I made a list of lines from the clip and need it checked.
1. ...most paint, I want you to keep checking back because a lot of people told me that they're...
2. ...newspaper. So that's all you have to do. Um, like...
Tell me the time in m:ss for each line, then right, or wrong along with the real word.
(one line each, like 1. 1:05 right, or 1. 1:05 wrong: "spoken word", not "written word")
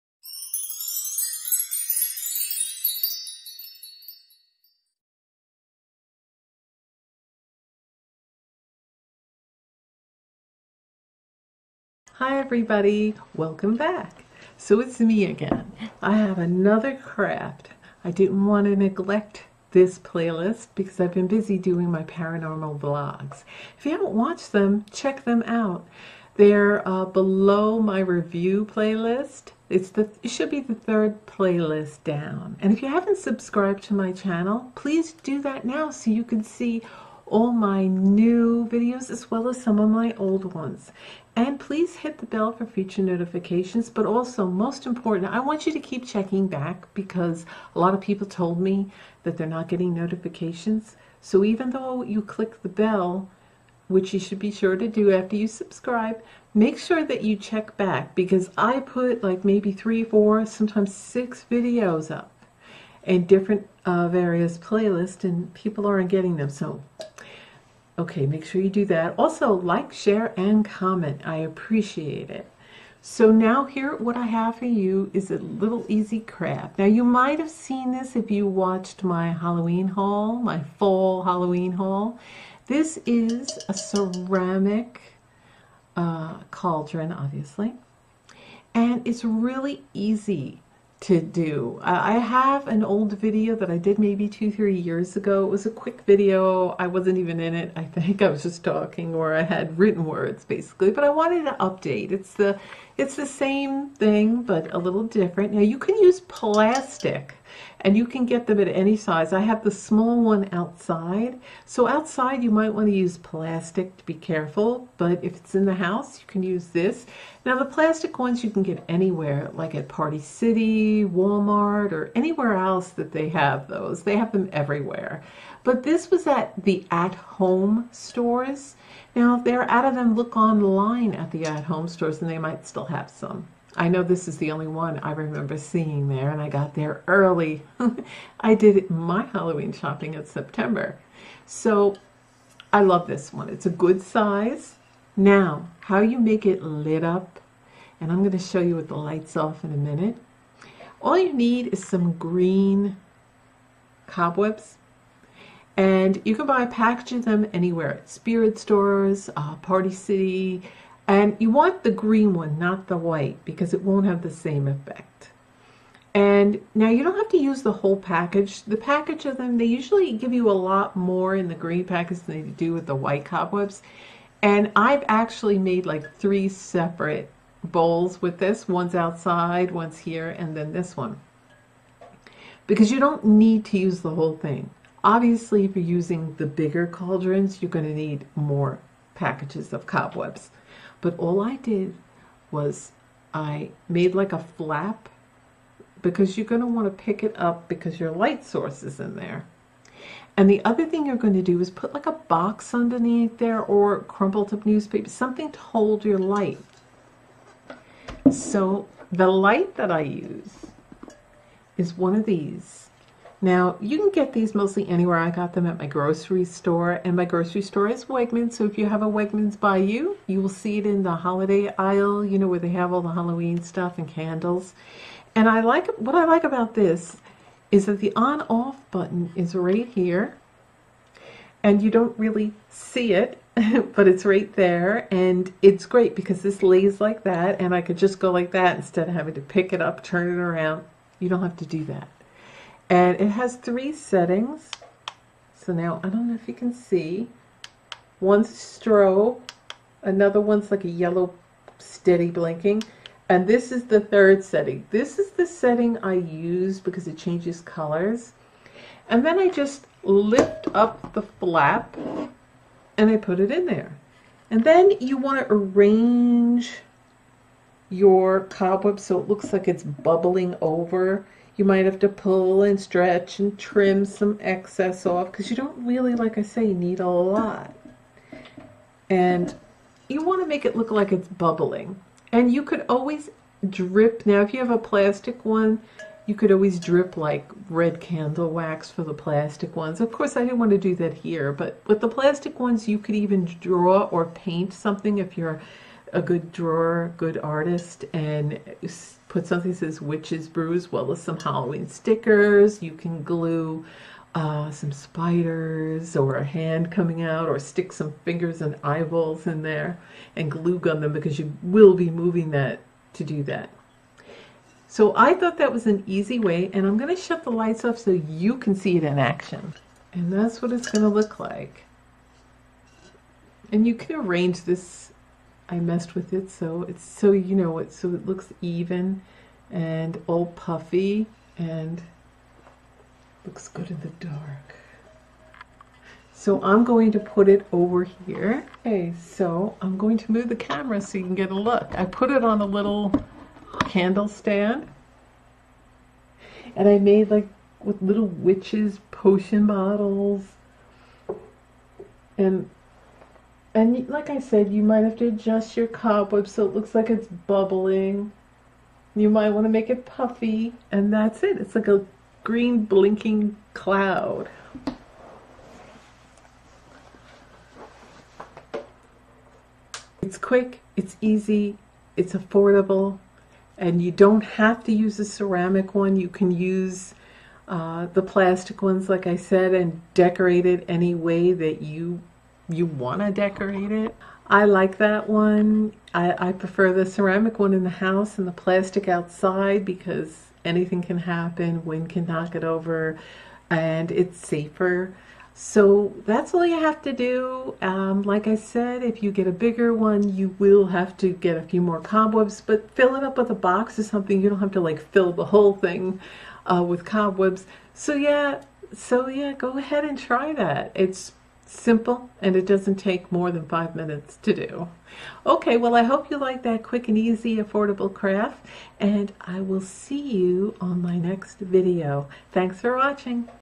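1. 0:44 wrong: "important", not "paint"
2. 6:34 wrong: "safer", not "newspaper".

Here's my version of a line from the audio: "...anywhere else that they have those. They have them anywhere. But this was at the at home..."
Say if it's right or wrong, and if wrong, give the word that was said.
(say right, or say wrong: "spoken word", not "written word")
wrong: "everywhere", not "anywhere".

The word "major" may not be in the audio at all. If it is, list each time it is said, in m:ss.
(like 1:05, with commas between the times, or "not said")
not said.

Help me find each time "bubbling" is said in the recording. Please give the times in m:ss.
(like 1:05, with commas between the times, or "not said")
4:29, 4:41, 5:57.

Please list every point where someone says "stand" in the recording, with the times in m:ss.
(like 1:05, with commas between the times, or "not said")
5:44.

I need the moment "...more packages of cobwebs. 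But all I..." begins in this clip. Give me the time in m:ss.
3:08.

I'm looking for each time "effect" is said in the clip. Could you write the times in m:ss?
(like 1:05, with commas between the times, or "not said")
2:44.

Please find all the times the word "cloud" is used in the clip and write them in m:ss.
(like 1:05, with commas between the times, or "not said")
6:03.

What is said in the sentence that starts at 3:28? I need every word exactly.
So the light that I use is one of these now, you can get these mostly anywhere.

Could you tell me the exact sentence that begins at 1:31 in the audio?
Uh, I have an old video that I did maybe two, three years ago.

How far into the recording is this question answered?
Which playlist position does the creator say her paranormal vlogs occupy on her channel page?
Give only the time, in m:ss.
0:30.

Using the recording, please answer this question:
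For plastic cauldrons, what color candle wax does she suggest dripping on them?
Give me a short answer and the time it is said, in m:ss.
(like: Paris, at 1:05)
red, at 4:47.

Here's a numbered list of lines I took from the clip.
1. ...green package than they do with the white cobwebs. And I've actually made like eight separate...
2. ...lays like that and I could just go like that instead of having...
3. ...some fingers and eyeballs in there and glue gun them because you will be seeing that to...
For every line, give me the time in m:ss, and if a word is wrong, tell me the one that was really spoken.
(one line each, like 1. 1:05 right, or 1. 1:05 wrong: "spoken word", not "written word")
1. 2:51 wrong: "three", not "eight"
2. 3:56 right
3. 5:07 wrong: "moving", not "seeing".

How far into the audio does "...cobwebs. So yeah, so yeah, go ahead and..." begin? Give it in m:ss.
6:47.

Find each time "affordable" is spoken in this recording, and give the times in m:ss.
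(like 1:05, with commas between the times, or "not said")
6:12, 6:57.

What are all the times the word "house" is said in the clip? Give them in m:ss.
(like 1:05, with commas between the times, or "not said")
1:55, 6:27.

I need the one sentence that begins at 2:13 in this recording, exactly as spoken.
I know this is the only one I remember seeing there, and I got there early.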